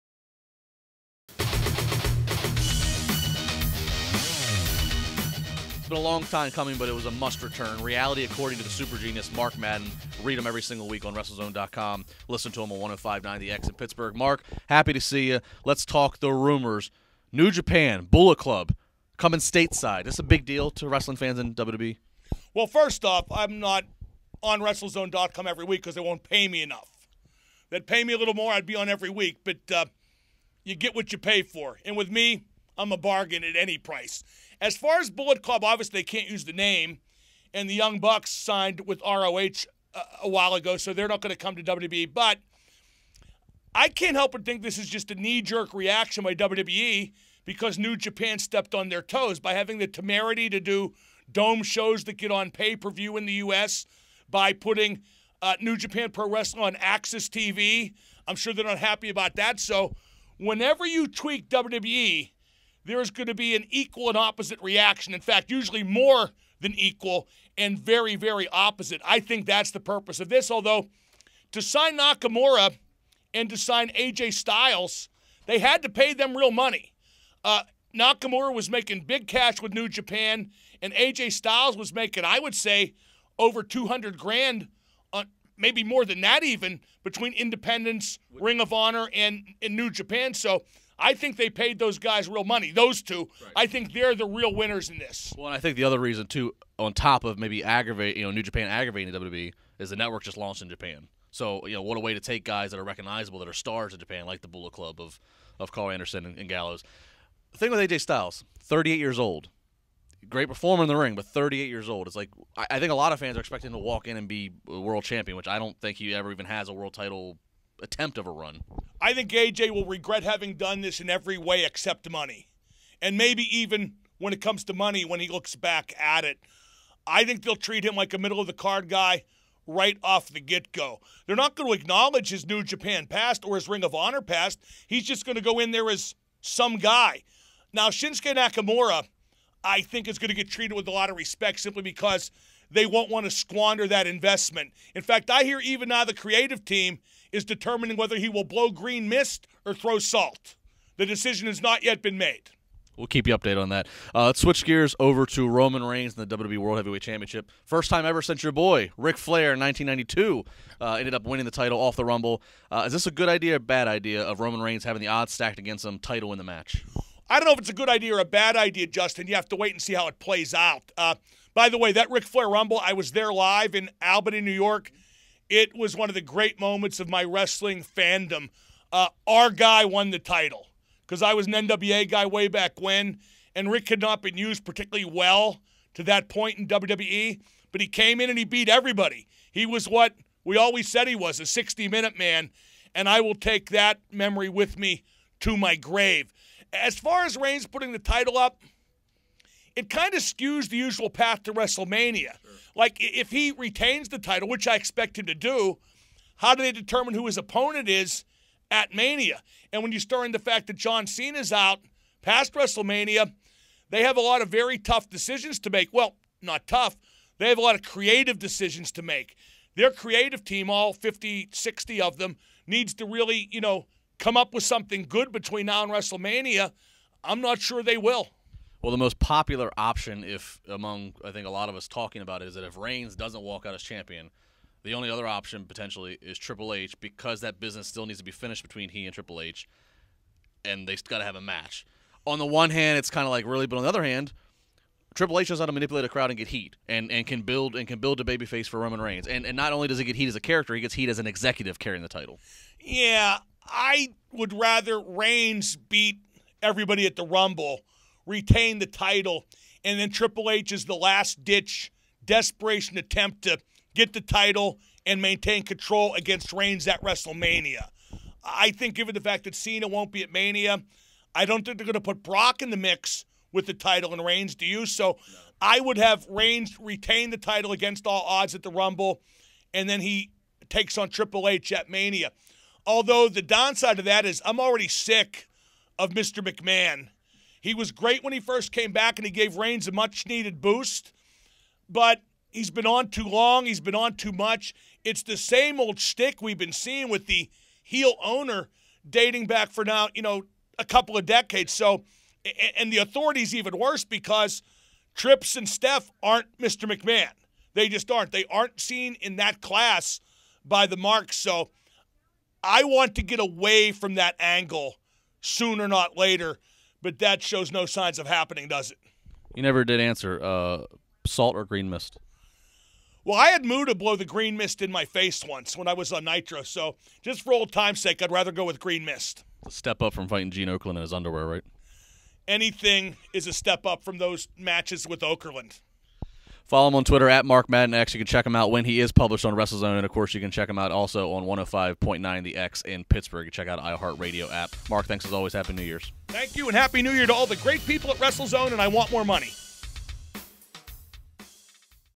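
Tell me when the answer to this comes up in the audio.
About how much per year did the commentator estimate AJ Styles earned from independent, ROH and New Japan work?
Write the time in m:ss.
1:23.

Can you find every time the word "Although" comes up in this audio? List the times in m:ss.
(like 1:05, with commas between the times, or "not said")
1:10, 4:42.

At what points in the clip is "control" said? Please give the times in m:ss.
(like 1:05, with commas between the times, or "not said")
4:25.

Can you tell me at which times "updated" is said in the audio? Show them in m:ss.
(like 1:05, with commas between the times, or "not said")
2:33.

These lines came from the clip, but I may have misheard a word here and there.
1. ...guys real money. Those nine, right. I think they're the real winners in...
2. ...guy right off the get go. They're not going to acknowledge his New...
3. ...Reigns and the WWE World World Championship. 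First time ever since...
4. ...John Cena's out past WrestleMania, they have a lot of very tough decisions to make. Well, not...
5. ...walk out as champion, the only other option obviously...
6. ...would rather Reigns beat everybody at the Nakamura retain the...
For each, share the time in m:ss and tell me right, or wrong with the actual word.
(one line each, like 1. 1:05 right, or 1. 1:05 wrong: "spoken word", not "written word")
1. 1:31 wrong: "two", not "nine"
2. 2:08 right
3. 2:35 wrong: "Heavyweight", not "World"
4. 3:30 right
5. 3:53 wrong: "potentially", not "obviously"
6. 4:14 wrong: "Rumble", not "Nakamura".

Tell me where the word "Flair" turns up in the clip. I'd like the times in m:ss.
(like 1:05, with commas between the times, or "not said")
2:39, 2:52.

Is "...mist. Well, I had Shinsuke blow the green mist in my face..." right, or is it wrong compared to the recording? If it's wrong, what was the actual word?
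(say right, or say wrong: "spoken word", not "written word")
wrong: "Muta", not "Shinsuke".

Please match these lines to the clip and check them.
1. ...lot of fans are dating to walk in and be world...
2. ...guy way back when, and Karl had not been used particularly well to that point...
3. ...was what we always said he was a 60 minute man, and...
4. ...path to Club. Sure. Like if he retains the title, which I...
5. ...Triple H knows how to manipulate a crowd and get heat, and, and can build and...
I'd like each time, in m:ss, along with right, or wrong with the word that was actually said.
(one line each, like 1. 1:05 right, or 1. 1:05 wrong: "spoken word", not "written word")
1. 1:52 wrong: "expecting", not "dating"
2. 3:02 wrong: "Ric", not "Karl"
3. 3:09 right
4. 3:21 wrong: "WrestleMania", not "Club"
5. 4:05 right.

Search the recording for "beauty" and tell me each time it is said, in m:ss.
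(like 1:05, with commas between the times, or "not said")
not said.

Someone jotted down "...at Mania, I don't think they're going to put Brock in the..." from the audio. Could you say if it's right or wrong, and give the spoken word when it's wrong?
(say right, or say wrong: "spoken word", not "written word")
right.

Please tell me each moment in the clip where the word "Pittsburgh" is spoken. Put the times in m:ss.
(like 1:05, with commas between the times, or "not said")
0:13, 5:43.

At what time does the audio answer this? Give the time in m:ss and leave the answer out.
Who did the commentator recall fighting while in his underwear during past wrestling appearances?
5:30.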